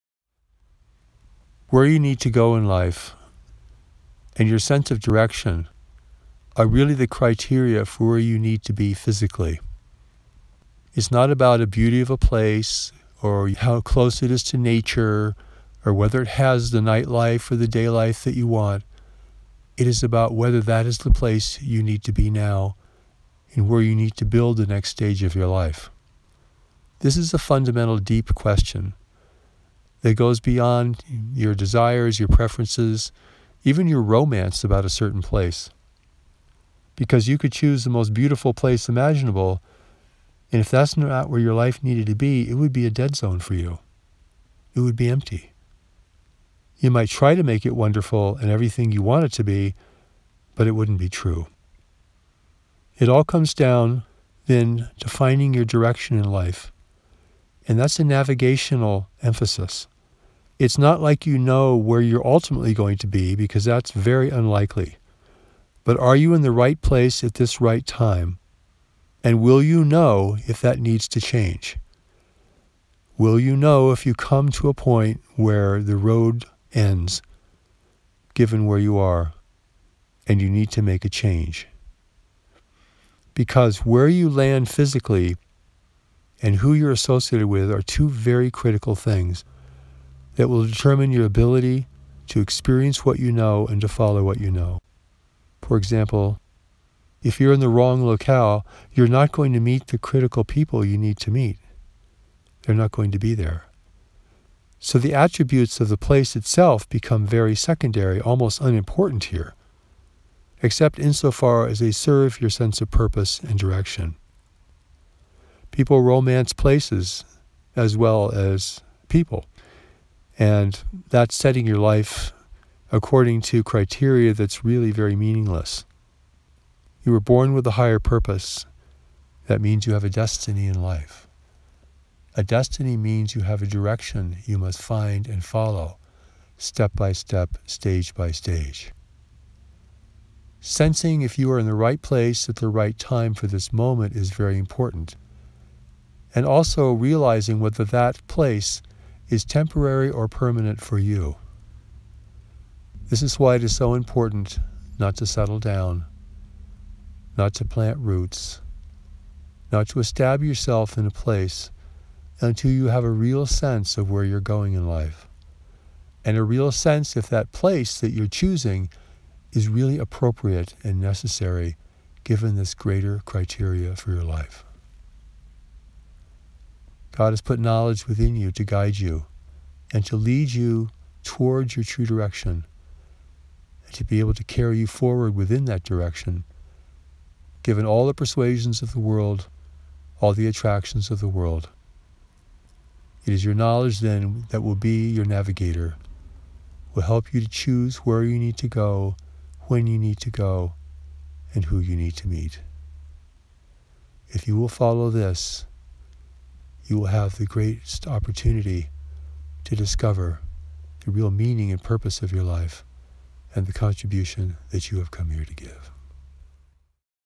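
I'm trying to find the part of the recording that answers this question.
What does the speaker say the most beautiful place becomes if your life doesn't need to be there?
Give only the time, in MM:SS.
00:42.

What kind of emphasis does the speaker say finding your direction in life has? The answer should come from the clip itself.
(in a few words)
navigational.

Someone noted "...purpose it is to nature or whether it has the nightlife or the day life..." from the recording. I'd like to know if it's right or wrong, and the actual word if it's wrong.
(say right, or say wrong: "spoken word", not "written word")
wrong: "close", not "purpose".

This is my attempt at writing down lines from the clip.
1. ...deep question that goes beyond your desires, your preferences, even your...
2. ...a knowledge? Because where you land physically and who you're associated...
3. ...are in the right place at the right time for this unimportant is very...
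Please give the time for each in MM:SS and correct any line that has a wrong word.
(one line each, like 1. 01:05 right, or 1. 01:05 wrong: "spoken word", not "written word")
1. 00:27 right
2. 01:21 wrong: "change", not "knowledge"
3. 02:21 wrong: "moment", not "unimportant".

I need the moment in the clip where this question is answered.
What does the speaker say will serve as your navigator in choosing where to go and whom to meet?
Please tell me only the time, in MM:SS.
03:13.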